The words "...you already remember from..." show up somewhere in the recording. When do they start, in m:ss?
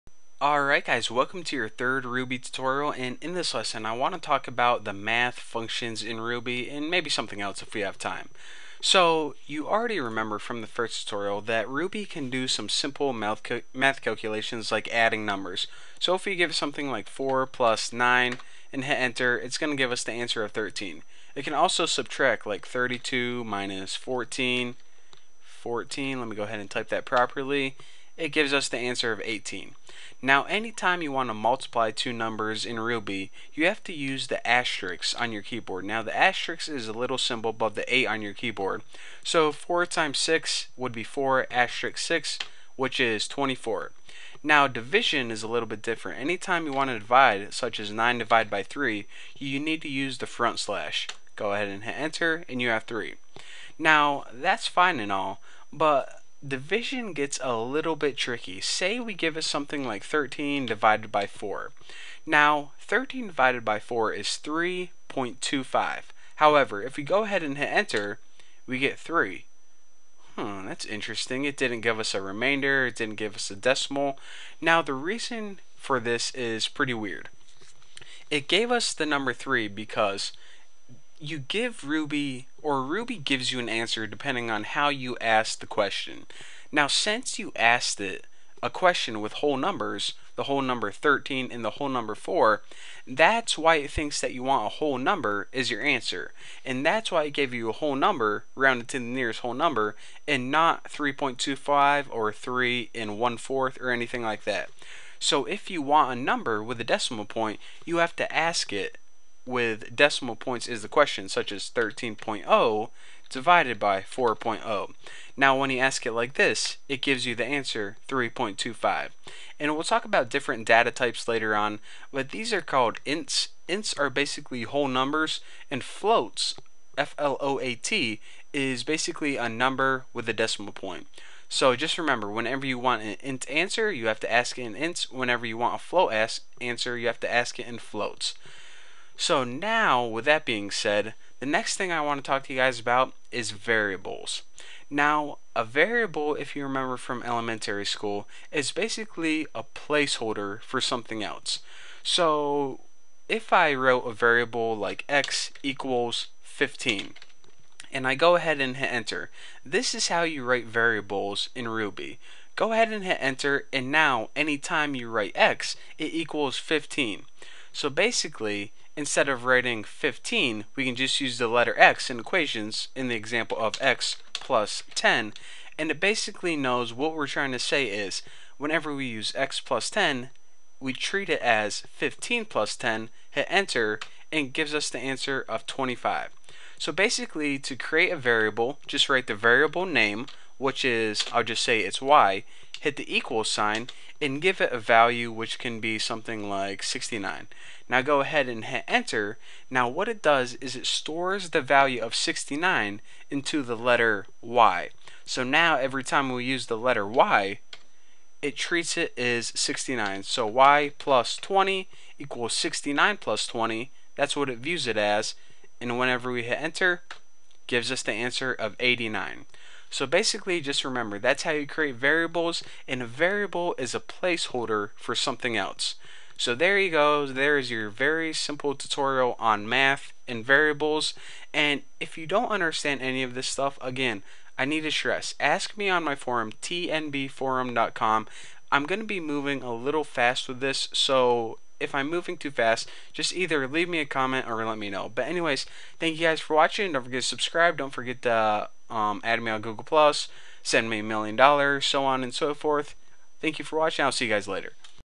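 0:09.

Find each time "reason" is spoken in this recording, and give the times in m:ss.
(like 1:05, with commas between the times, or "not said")
1:14.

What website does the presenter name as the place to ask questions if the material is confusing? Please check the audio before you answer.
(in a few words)
tnbforum.com.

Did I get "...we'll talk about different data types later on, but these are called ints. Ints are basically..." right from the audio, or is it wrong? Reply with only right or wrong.
right.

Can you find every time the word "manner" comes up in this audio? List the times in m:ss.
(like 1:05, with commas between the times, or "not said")
not said.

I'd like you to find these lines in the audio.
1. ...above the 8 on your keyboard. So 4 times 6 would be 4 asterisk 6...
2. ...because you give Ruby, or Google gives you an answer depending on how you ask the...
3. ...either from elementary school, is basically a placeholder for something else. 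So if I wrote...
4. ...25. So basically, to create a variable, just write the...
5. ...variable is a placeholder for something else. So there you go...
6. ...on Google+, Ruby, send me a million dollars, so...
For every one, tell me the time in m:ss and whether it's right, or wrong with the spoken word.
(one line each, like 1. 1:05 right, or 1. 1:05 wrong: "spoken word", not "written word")
1. 0:37 right
2. 1:19 wrong: "Ruby", not "Google"
3. 2:26 wrong: "remember", not "either"
4. 3:05 right
5. 3:43 right
6. 4:09 wrong: "Plus", not "Ruby".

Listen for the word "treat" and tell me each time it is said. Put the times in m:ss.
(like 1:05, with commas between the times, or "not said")
3:00, 3:28.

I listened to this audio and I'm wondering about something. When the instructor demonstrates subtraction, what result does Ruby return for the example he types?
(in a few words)
18.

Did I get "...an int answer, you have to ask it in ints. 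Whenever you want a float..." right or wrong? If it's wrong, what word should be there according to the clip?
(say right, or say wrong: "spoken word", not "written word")
right.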